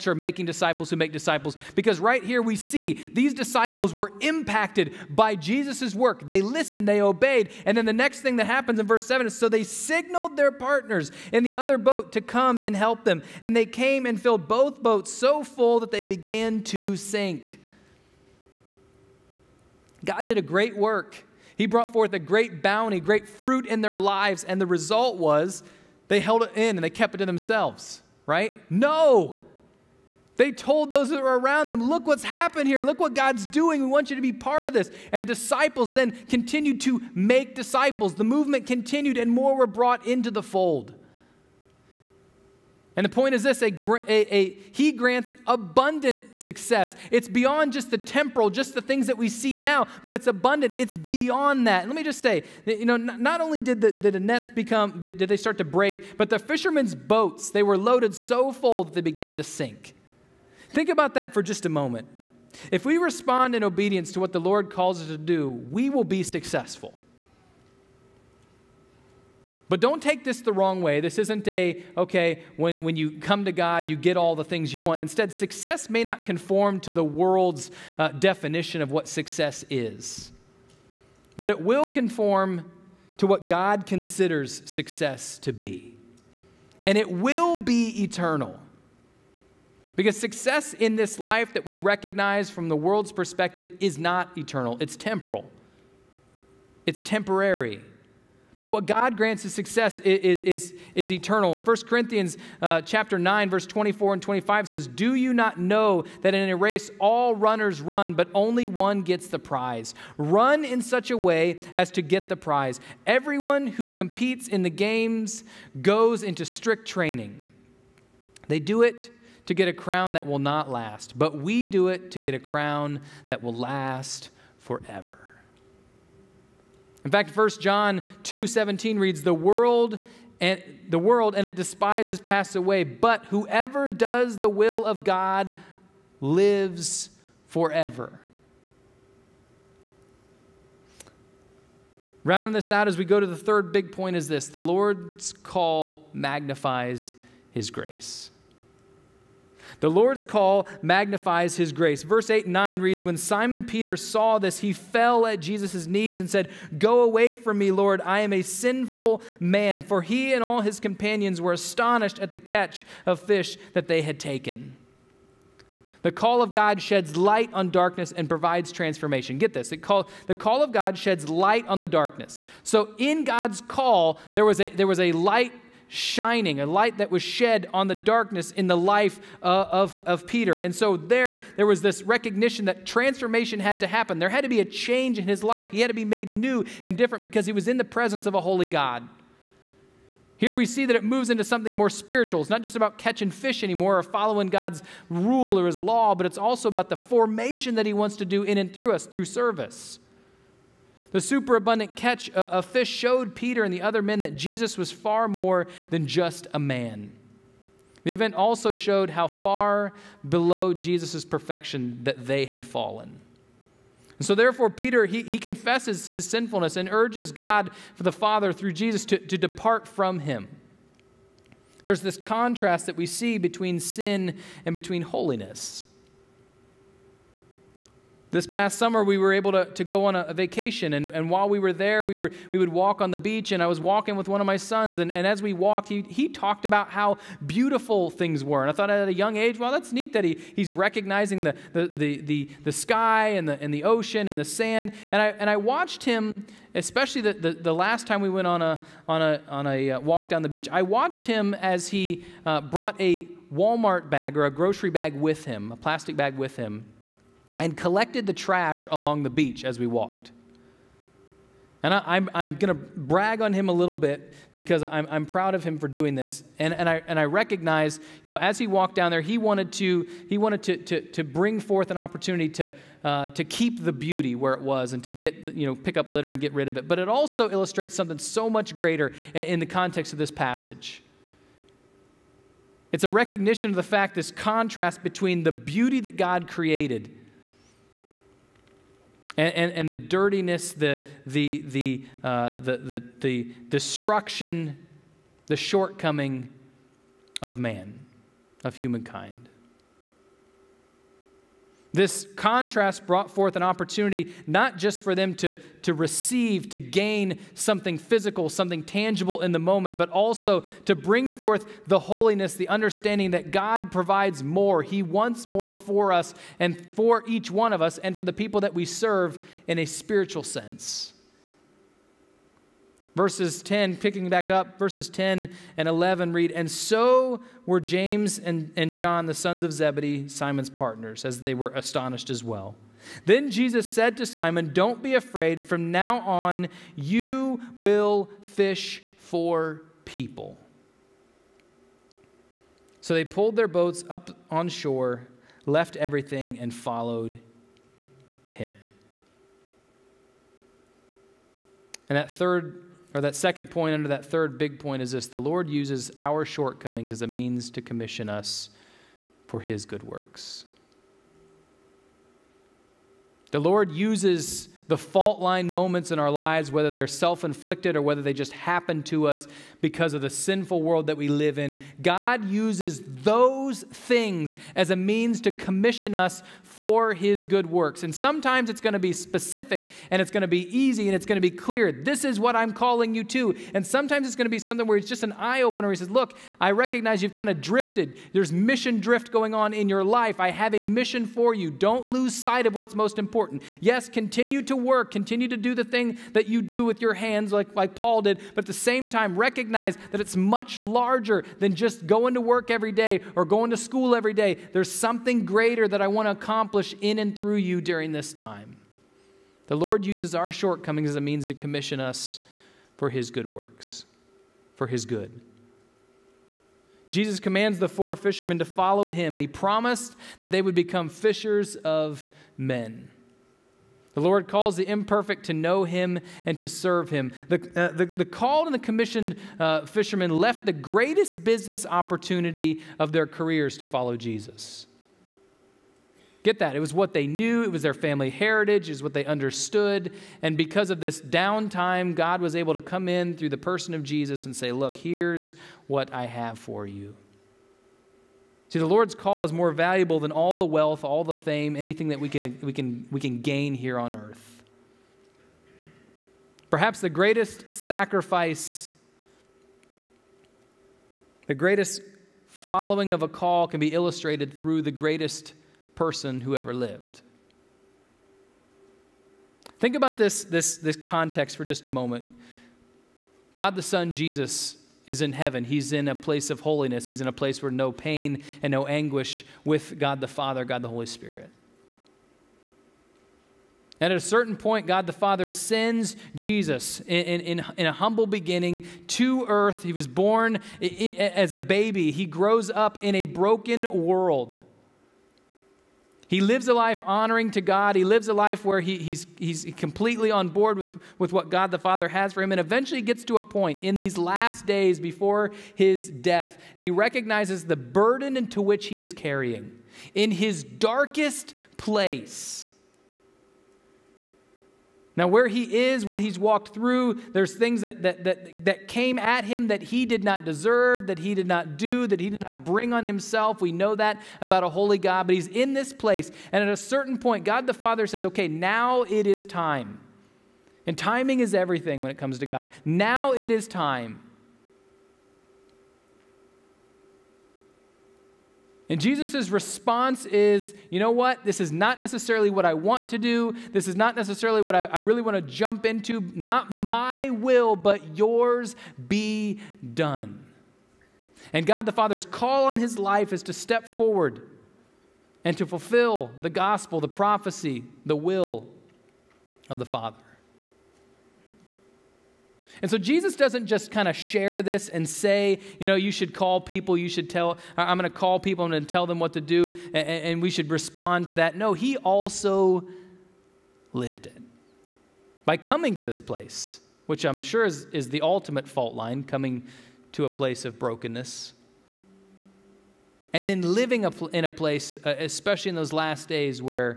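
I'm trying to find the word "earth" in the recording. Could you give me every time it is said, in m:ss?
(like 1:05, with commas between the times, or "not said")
7:34, 8:09.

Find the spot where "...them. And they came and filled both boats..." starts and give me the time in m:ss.
0:13.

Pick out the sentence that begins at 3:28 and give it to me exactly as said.
The event also showed how far below Jesus' perfection that they had fallen.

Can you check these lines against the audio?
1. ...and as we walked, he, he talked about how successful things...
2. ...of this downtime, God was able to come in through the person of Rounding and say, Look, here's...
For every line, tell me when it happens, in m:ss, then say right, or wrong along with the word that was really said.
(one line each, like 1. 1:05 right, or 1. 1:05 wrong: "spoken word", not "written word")
1. 3:55 wrong: "beautiful", not "successful"
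2. 7:20 wrong: "Jesus", not "Rounding".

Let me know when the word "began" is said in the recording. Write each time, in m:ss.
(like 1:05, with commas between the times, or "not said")
0:16, 0:59.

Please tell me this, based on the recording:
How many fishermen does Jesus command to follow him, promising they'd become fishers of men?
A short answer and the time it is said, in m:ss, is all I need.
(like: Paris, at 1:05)
4, at 6:57.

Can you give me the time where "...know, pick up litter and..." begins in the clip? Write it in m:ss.
4:35.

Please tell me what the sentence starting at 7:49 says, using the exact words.
Think about this, this, this context for just a moment.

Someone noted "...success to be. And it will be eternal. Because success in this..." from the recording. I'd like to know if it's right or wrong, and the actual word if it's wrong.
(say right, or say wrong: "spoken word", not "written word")
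right.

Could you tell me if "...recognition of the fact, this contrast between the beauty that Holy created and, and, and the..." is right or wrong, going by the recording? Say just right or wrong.
wrong.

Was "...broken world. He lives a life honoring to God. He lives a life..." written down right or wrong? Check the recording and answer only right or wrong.
right.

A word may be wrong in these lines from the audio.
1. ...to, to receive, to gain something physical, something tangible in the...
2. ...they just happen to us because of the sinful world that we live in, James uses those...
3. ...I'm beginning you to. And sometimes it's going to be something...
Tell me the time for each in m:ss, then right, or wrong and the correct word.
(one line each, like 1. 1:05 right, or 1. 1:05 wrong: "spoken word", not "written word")
1. 5:05 right
2. 6:08 wrong: "God", not "James"
3. 6:22 wrong: "calling", not "beginning".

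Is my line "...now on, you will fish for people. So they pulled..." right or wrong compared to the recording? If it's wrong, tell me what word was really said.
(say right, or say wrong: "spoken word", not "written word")
right.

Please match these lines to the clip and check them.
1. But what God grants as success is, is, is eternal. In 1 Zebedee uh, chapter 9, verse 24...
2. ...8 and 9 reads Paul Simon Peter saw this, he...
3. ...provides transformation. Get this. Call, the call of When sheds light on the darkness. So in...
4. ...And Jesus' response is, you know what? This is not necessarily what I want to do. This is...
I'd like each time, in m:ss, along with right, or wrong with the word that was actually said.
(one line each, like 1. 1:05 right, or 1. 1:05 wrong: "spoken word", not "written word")
1. 1:38 wrong: "Corinthians", not "Zebedee"
2. 2:32 wrong: "When", not "Paul"
3. 2:48 wrong: "God", not "When"
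4. 8:58 right.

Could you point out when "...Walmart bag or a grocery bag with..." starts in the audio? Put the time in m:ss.
4:13.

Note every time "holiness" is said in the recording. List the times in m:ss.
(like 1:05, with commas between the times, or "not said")
3:45, 5:11, 7:56.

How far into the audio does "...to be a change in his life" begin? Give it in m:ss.
3:04.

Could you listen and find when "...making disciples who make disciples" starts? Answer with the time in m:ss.
0:00.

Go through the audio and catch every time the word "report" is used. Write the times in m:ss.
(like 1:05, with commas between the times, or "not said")
not said.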